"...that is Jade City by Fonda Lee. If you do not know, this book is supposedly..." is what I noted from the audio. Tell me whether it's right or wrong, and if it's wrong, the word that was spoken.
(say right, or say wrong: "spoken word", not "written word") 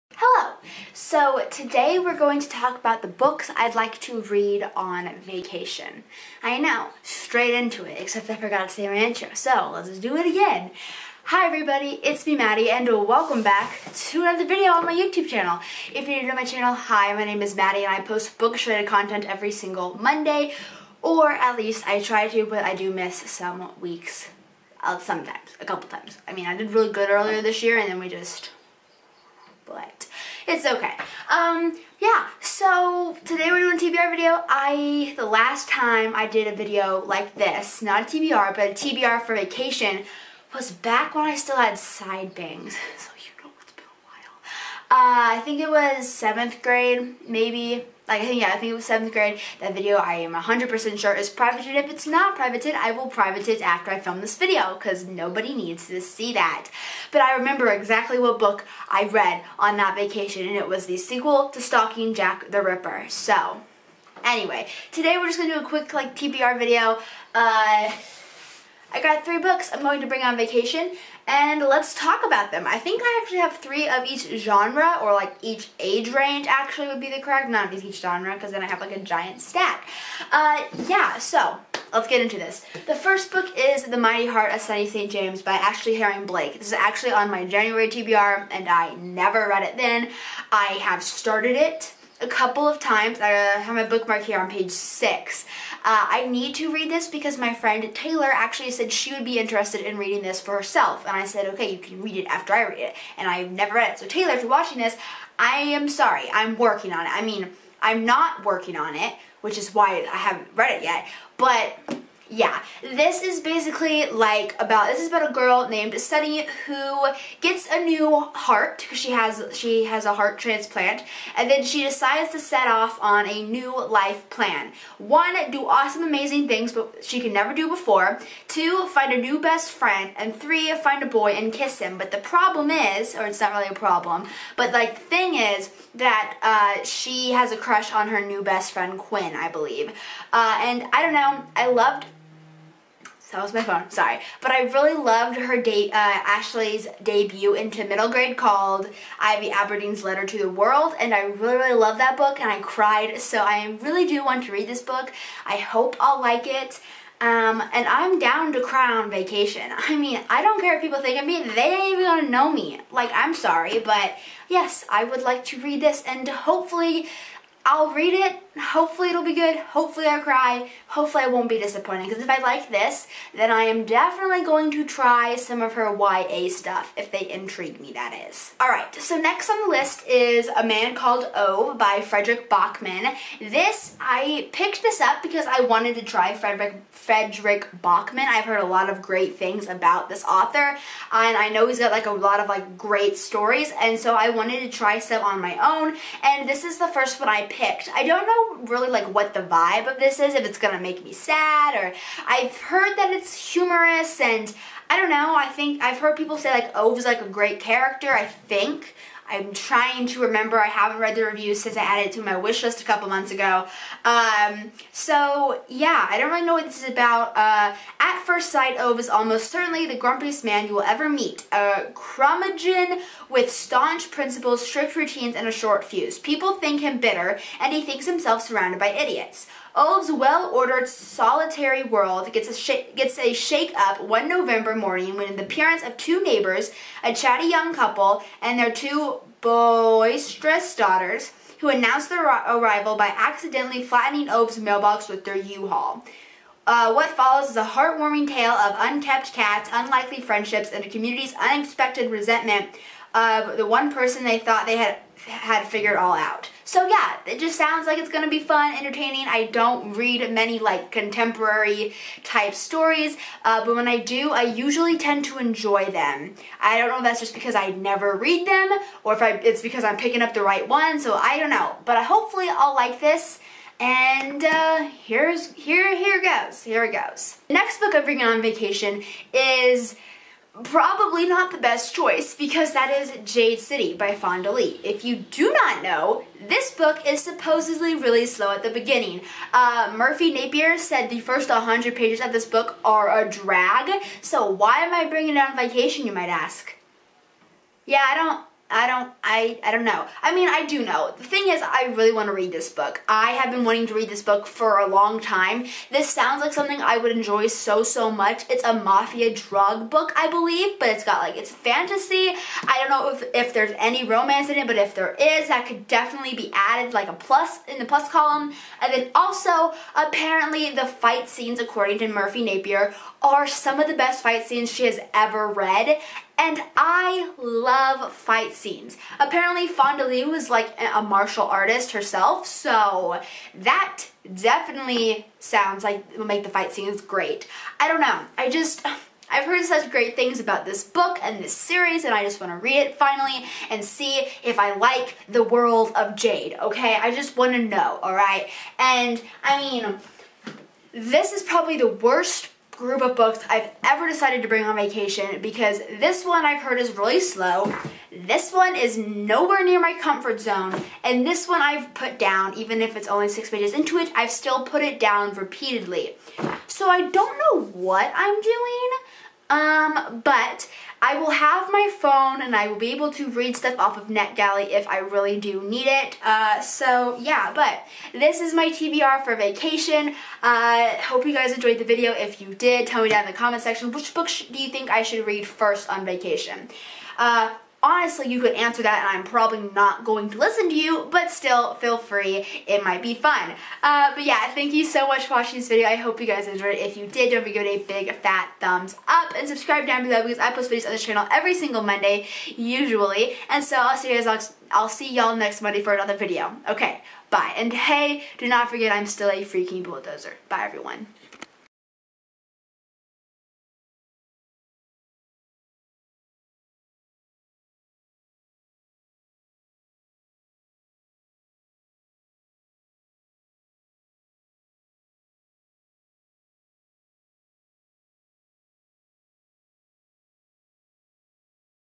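right.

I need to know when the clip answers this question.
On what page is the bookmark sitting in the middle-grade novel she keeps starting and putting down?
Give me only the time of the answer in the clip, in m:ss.
1:34.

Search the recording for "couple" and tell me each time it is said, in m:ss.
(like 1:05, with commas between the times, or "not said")
0:25, 1:32, 3:32, 3:57.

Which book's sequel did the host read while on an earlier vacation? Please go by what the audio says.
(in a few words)
Stalking Jack the Ripper.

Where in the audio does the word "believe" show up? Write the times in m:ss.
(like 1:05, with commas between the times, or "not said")
2:19, 5:10.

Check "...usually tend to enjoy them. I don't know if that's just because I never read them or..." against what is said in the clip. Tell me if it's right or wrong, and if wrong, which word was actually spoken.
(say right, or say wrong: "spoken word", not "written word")
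right.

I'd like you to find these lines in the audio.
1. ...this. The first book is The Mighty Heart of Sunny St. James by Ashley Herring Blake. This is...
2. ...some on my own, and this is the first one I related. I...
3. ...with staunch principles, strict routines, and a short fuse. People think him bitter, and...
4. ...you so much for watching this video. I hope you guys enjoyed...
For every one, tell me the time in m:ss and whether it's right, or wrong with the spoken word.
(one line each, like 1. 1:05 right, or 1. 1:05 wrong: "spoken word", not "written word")
1. 1:22 right
2. 3:14 wrong: "picked", not "related"
3. 3:43 right
4. 6:34 right.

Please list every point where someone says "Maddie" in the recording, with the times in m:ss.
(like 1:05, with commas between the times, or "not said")
0:12, 0:17.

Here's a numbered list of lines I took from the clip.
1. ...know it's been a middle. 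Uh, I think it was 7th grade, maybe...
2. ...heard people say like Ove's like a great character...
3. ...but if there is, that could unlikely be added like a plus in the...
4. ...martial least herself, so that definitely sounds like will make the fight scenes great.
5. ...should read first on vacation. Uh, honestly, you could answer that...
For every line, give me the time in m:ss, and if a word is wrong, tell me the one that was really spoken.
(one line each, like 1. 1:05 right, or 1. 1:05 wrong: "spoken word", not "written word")
1. 0:43 wrong: "while", not "middle"
2. 3:25 right
3. 5:14 wrong: "definitely", not "unlikely"
4. 5:31 wrong: "artist", not "least"
5. 6:25 right.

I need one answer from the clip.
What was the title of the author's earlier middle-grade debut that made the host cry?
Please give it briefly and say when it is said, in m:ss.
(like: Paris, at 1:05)
Ivy Aberdeen's Letter to the World, at 2:29.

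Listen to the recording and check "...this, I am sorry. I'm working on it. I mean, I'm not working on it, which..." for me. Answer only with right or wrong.
right.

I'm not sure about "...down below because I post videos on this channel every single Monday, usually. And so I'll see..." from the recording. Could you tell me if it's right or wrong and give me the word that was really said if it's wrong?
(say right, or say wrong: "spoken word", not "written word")
right.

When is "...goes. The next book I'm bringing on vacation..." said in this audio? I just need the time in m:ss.
4:36.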